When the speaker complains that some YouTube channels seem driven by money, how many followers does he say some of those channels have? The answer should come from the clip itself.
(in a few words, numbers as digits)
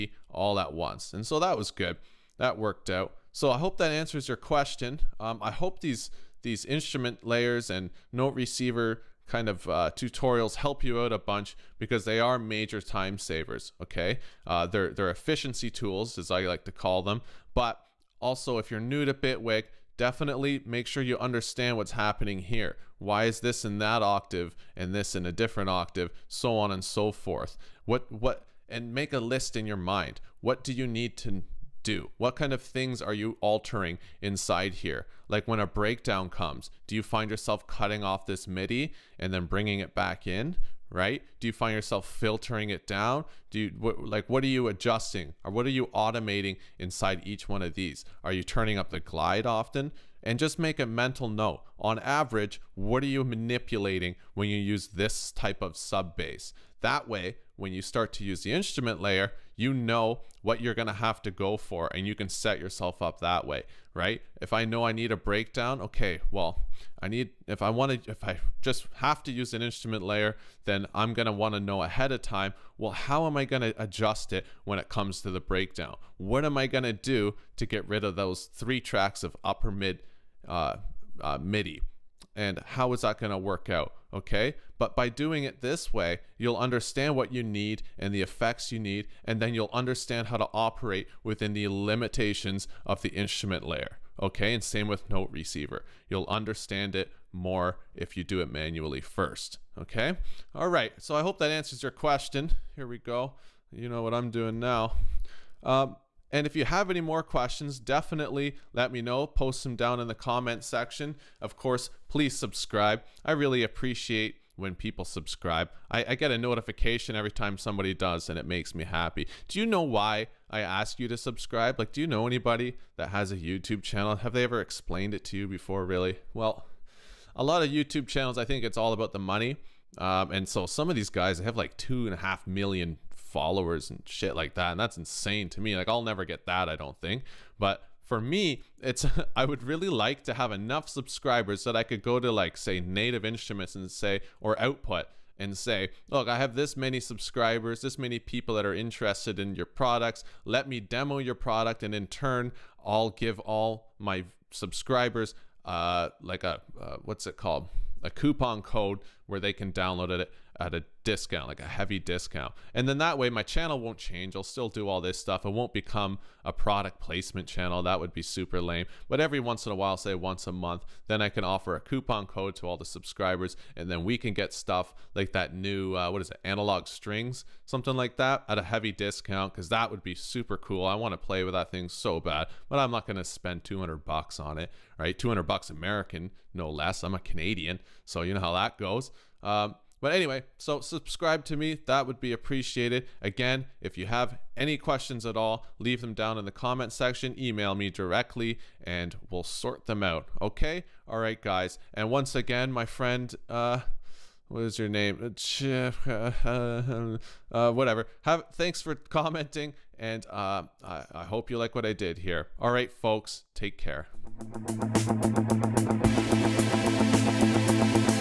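2.5 million.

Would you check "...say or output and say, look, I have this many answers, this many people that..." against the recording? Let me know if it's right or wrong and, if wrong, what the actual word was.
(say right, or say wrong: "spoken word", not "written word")
wrong: "subscribers", not "answers".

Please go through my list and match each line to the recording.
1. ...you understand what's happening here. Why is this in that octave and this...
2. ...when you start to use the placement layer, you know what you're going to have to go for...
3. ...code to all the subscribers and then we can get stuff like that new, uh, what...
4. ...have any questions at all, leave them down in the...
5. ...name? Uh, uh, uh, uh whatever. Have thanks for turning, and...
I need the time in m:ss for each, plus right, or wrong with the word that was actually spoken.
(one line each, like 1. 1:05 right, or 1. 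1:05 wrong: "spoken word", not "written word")
1. 0:21 right
2. 0:57 wrong: "instrument", not "placement"
3. 2:52 right
4. 3:14 right
5. 3:24 wrong: "commenting", not "turning".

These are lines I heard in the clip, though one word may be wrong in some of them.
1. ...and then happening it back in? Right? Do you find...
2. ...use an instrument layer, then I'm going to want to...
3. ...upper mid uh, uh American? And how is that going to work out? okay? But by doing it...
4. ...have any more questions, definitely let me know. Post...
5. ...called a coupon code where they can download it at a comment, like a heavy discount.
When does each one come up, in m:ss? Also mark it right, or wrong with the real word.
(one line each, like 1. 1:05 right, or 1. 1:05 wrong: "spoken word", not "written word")
1. 0:39 wrong: "bringing", not "happening"
2. 1:09 right
3. 1:19 wrong: "MIDI", not "American"
4. 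1:46 right
5. 2:37 wrong: "discount", not "comment".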